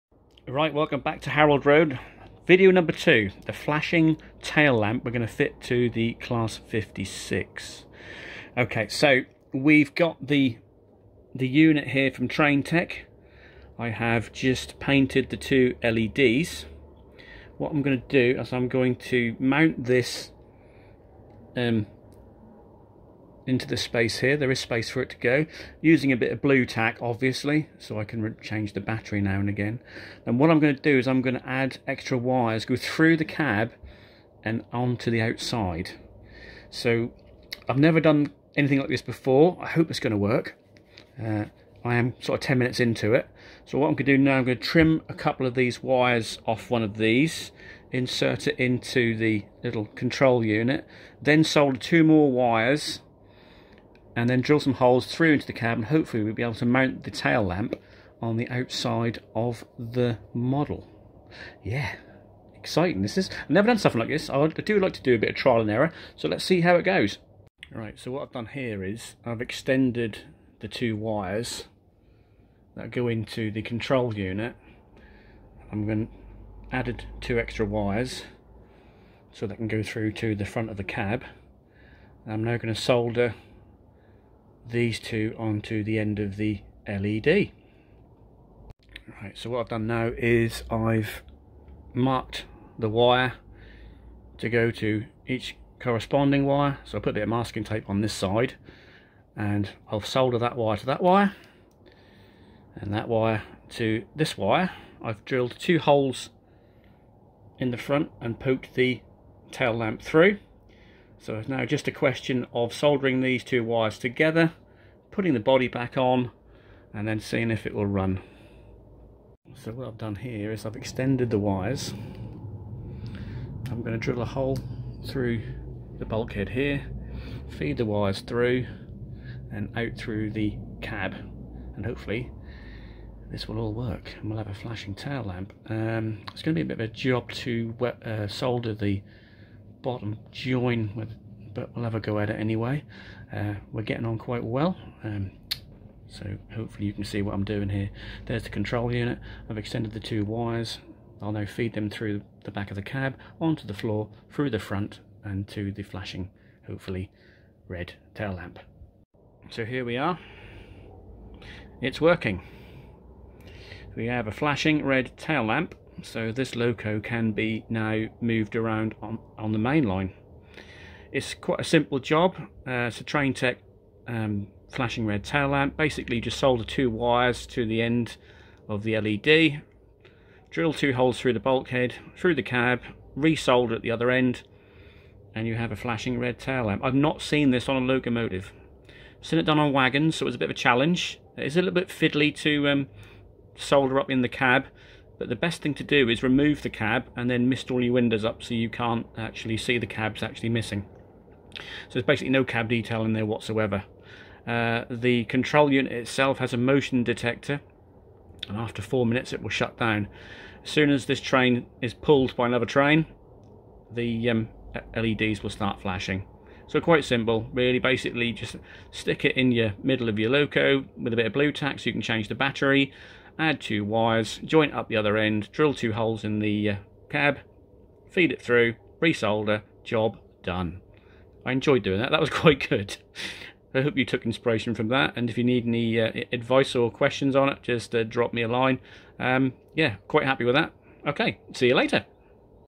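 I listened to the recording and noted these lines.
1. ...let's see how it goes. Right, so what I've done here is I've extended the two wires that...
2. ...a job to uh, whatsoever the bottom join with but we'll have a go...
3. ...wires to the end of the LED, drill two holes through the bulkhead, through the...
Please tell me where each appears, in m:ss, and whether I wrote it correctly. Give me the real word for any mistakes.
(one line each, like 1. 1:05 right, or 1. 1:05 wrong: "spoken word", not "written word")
1. 1:06 right
2. 2:16 wrong: "solder", not "whatsoever"
3. 2:56 right.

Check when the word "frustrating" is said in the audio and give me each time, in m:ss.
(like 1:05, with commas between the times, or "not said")
not said.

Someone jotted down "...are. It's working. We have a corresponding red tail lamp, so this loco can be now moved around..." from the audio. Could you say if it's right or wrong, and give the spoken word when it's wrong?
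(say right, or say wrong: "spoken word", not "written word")
wrong: "flashing", not "corresponding".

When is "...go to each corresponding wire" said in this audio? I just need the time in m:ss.
1:34.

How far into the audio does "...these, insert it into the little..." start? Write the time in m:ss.
0:46.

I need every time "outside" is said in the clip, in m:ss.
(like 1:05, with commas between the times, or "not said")
0:35, 0:58.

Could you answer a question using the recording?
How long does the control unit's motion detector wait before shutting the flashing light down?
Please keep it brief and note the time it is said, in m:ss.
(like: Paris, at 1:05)
4 minutes, at 3:28.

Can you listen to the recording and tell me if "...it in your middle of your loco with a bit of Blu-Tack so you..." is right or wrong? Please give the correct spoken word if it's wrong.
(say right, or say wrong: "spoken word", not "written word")
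right.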